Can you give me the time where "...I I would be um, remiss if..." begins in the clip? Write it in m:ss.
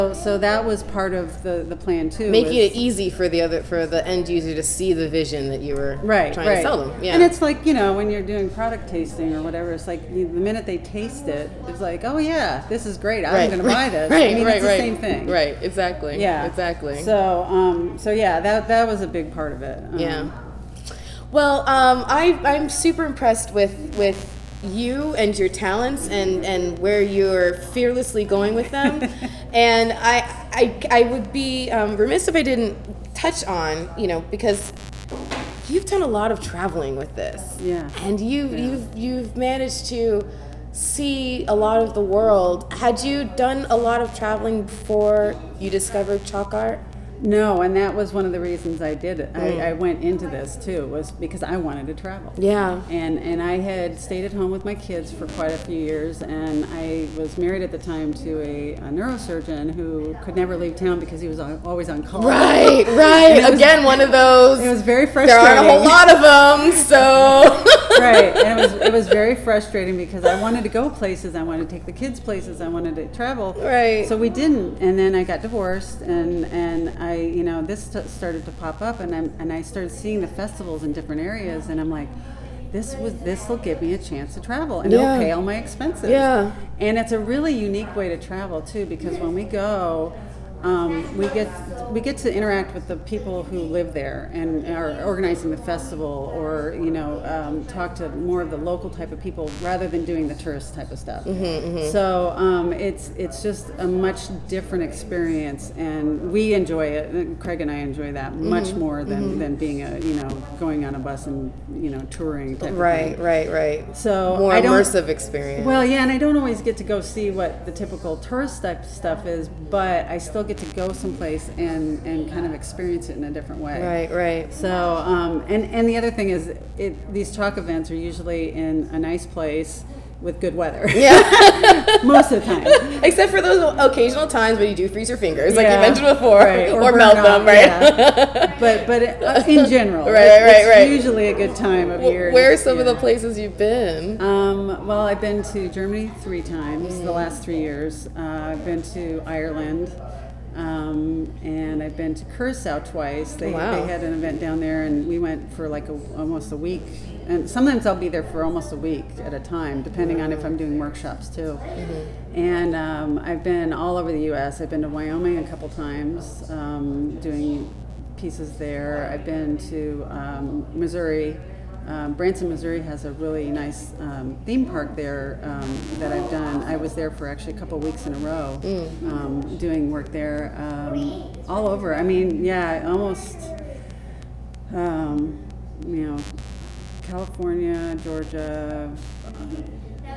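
0:30.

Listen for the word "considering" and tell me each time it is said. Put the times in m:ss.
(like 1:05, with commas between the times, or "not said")
not said.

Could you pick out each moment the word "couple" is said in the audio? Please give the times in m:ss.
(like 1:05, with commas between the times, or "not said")
2:45, 2:57.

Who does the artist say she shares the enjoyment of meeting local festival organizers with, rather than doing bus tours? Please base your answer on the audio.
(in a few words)
Craig.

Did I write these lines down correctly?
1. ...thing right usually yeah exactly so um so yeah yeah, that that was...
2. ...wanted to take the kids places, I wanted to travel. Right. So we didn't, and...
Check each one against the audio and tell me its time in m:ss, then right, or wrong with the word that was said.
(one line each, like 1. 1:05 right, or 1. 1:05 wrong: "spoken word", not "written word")
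1. 0:14 wrong: "exactly", not "usually"
2. 1:11 right.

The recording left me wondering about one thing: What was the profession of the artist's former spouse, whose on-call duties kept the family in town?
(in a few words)
Neurosurgeon.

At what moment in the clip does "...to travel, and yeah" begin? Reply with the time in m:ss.
1:24.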